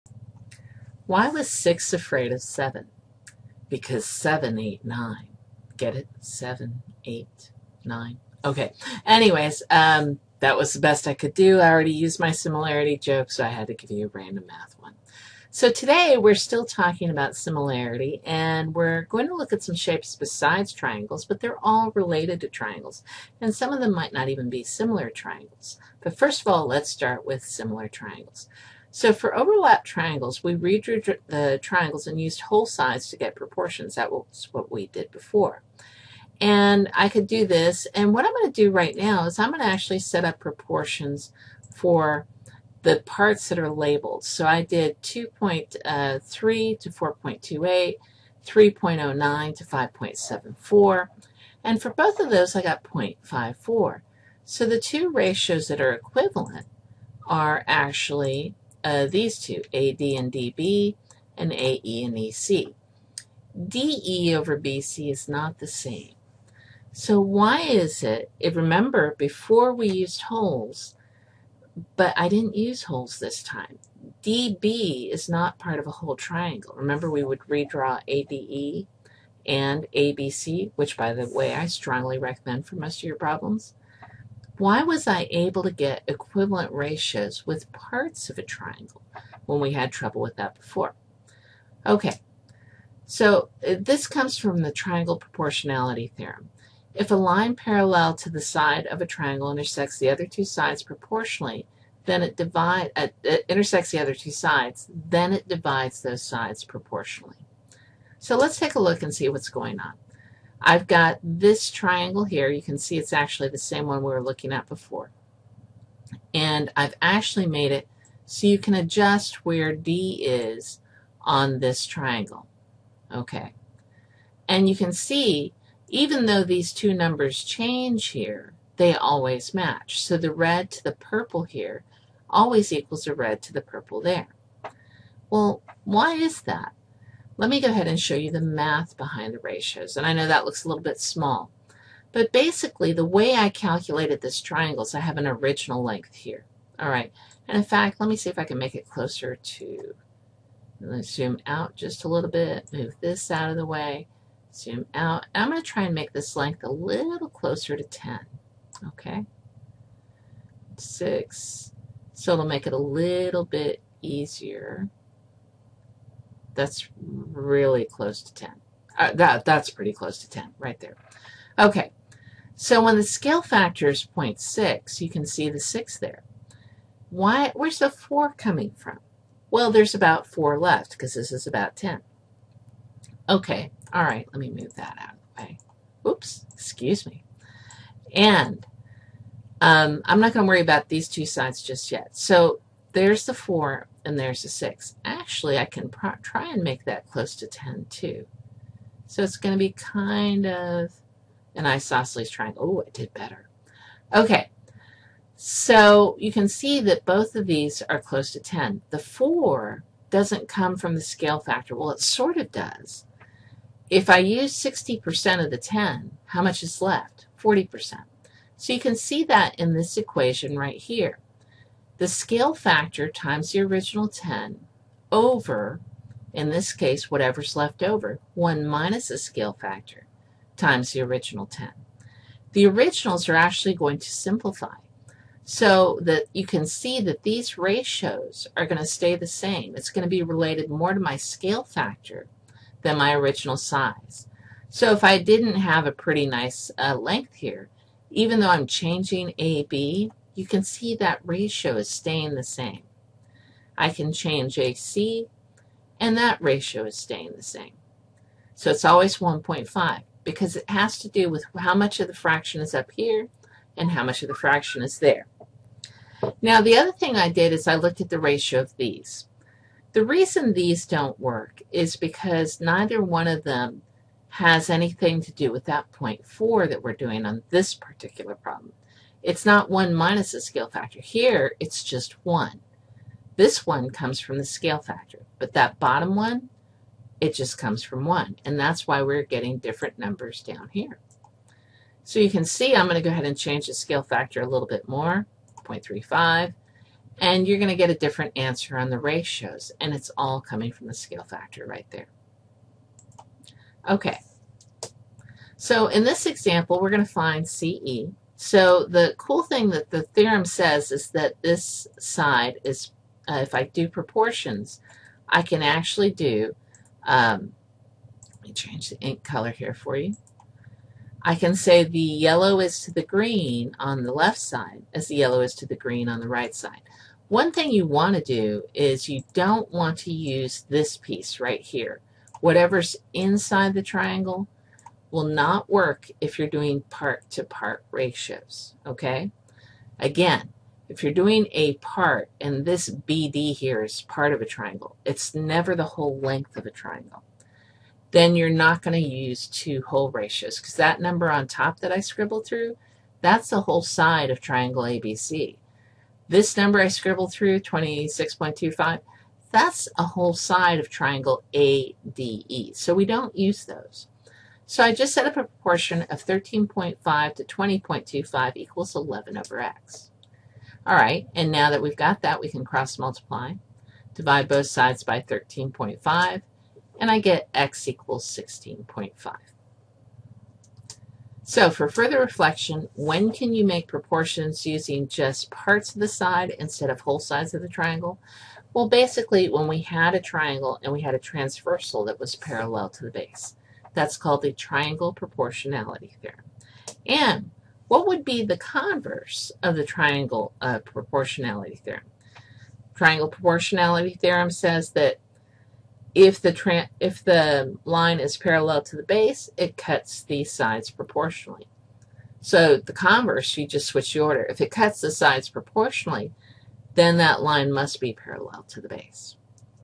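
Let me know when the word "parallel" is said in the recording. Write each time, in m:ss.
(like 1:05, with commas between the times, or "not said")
1:37, 6:32, 6:48, 6:58.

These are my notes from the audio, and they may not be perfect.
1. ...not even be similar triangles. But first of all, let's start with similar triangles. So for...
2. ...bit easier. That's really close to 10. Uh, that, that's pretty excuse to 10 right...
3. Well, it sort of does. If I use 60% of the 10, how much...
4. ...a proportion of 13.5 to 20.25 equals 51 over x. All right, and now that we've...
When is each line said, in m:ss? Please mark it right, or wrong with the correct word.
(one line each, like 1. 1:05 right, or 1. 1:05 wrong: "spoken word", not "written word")
1. 0:24 right
2. 2:43 wrong: "close", not "excuse"
3. 3:31 right
4. 6:05 wrong: "11", not "51".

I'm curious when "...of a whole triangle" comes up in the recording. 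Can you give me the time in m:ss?
1:15.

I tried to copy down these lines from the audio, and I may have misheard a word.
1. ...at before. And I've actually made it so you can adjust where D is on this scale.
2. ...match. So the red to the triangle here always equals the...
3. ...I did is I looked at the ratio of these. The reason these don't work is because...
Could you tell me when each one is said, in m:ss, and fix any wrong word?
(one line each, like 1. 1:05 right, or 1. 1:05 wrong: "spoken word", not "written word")
1. 1:54 wrong: "triangle", not "scale"
2. 2:09 wrong: "purple", not "triangle"
3. 4:27 right.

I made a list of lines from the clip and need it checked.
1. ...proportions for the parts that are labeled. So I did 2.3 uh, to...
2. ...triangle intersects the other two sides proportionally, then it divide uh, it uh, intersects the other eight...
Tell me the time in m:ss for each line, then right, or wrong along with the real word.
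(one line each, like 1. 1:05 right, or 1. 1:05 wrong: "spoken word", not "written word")
1. 0:40 right
2. 1:39 wrong: "two", not "eight".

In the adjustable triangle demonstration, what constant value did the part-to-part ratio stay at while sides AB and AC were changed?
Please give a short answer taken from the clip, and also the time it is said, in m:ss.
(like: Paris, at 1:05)
1.5, at 4:19.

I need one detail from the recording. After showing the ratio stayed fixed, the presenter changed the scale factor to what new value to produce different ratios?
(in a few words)
0.35.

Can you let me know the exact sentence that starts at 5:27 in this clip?
One thing you want to do is you don't want to use this piece right here.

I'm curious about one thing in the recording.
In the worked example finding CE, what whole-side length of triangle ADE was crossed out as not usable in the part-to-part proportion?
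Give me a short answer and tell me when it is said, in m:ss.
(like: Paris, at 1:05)
26.25, at 5:57.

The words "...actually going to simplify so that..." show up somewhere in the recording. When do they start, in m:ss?
3:53.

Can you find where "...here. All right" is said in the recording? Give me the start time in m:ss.
2:26.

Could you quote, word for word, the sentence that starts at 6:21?
So for further reflection, when can you make proportions using just parts of the side instead of whole sides of the triangle?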